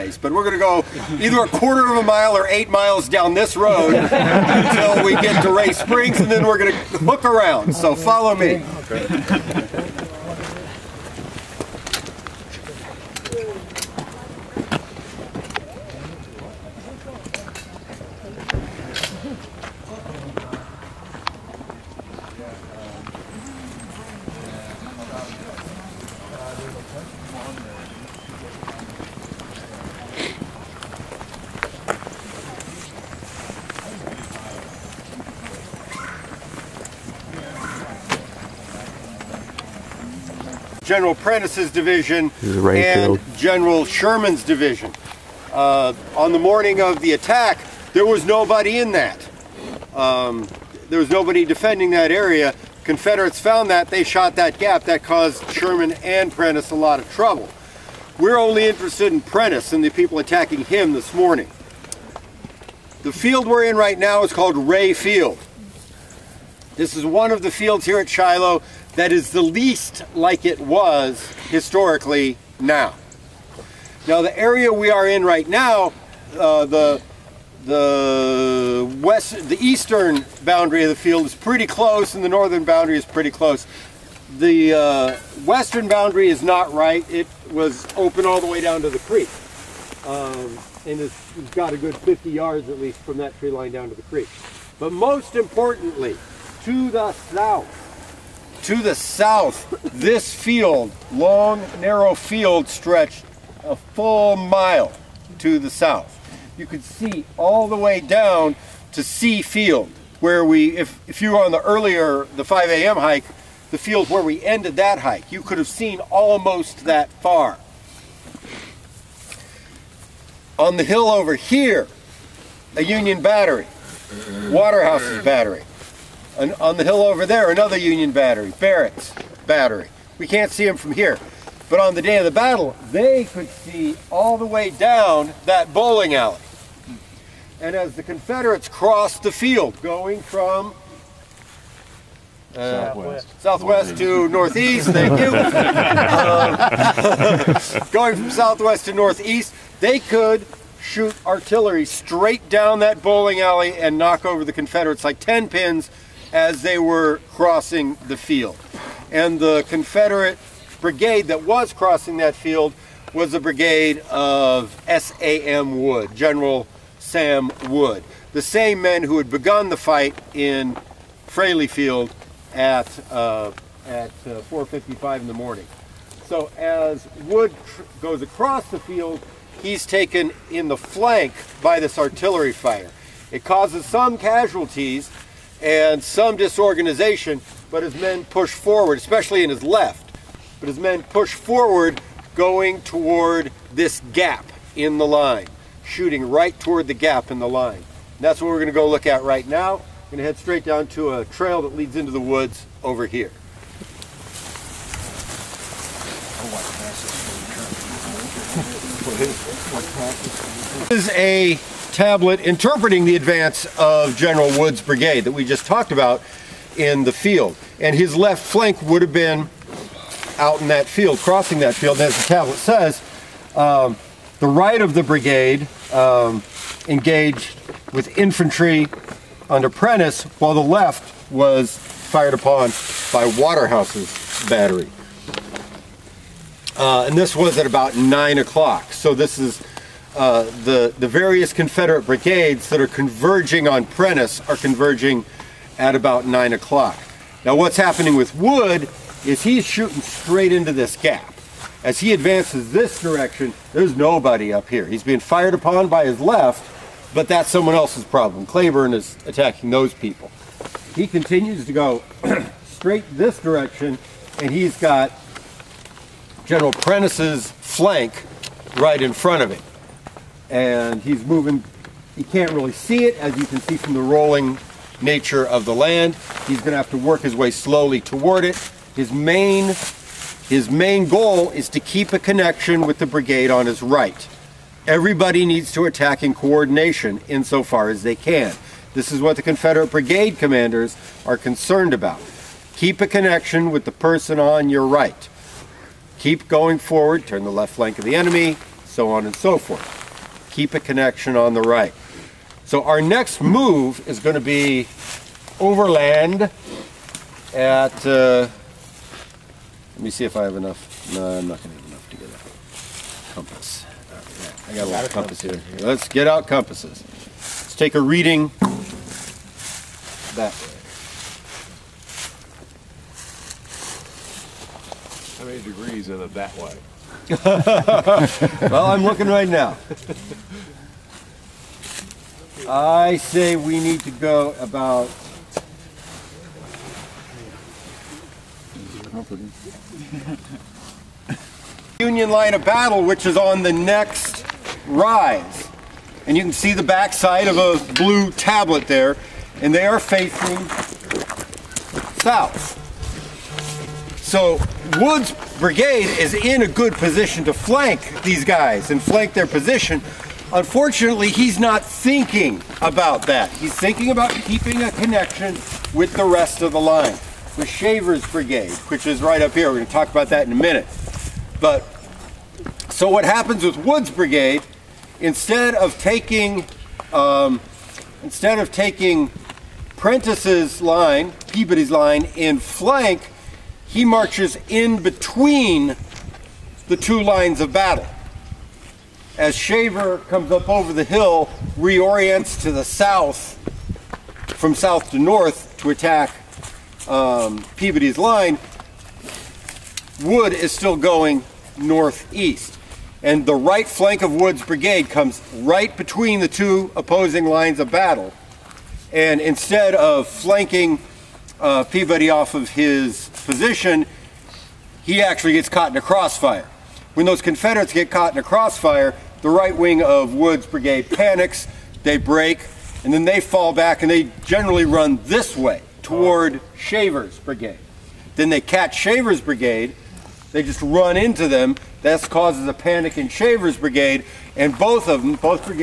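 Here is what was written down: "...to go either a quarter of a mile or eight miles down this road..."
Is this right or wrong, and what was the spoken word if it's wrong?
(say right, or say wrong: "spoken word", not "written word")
right.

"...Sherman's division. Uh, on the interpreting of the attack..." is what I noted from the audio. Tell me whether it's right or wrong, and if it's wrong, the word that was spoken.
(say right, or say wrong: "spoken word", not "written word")
wrong: "morning", not "interpreting".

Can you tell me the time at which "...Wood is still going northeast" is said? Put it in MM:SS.
06:40.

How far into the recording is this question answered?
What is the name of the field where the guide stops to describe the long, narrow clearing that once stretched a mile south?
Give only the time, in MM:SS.
01:04.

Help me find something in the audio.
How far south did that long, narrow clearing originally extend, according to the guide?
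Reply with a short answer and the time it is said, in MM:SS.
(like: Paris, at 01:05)
a full mile, at 01:43.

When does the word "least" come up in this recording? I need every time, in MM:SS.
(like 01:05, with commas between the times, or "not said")
01:09, 01:32.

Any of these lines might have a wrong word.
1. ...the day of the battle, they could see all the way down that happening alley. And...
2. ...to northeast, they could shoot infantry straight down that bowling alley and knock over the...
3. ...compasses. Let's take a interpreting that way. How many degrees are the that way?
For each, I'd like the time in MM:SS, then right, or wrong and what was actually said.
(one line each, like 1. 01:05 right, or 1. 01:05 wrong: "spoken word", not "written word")
1. 02:11 wrong: "bowling", not "happening"
2. 02:28 wrong: "artillery", not "infantry"
3. 05:16 wrong: "reading", not "interpreting".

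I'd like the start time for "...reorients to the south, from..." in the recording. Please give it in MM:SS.
06:31.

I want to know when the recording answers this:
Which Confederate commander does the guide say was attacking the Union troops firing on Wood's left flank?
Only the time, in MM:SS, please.
04:18.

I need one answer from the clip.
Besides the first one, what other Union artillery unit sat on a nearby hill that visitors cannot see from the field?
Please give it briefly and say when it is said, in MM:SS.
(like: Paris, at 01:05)
Barrett's battery, at 02:08.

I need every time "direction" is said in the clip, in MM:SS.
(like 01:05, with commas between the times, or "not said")
04:12, 04:23.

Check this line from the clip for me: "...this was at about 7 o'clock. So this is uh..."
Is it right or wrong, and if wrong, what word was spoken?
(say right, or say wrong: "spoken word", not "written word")
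wrong: "9", not "7".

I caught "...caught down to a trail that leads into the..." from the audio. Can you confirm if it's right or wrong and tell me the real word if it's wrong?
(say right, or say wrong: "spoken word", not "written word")
wrong: "straight", not "caught".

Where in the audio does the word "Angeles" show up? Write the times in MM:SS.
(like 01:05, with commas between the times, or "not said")
not said.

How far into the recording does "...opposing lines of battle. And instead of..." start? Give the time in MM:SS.
06:46.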